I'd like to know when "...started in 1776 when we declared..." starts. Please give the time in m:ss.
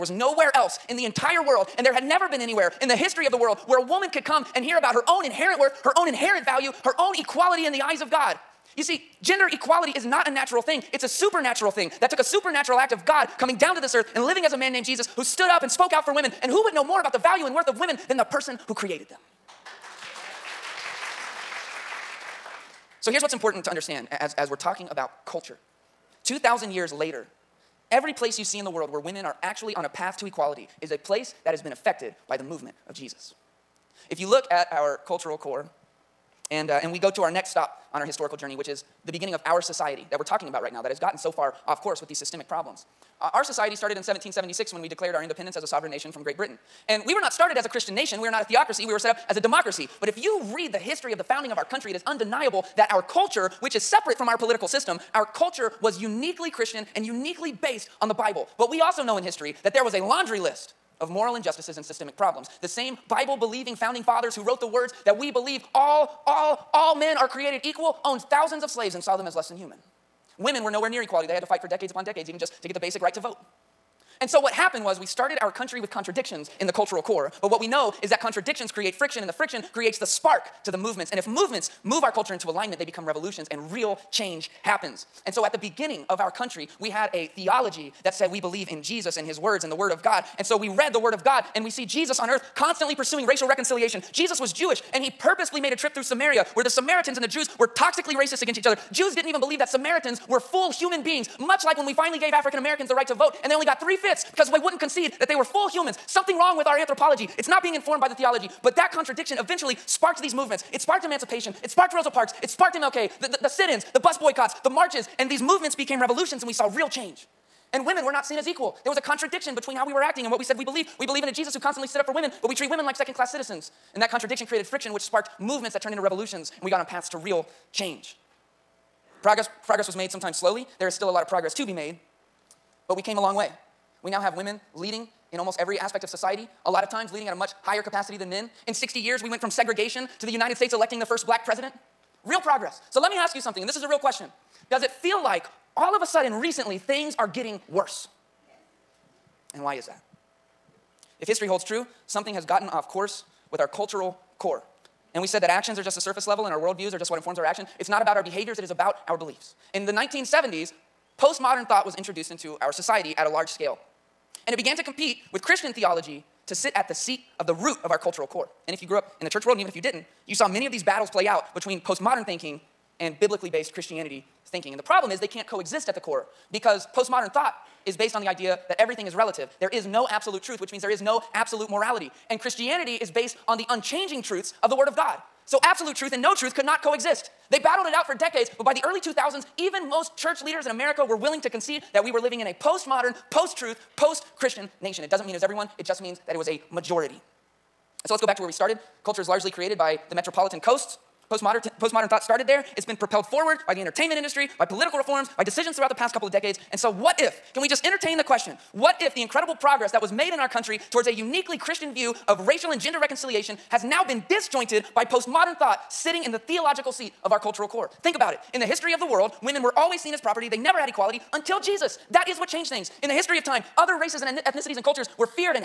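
0:43.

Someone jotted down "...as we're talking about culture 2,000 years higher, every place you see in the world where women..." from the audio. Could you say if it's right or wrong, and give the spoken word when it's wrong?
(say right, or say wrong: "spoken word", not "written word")
wrong: "later", not "higher".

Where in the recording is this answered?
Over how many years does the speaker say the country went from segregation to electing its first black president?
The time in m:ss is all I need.
2:18.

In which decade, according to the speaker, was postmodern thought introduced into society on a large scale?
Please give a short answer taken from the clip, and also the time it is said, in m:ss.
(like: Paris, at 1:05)
1970s, at 2:39.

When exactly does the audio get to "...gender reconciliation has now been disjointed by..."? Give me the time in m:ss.
3:32.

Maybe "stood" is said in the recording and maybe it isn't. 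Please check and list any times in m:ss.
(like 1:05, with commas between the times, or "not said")
0:15, 2:01.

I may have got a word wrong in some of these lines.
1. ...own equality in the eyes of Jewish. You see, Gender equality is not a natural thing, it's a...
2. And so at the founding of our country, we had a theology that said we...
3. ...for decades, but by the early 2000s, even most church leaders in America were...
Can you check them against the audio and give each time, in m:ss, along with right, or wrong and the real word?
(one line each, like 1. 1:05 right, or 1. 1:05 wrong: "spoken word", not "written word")
1. 0:06 wrong: "God", not "Jewish"
2. 1:25 wrong: "beginning", not "founding"
3. 3:08 right.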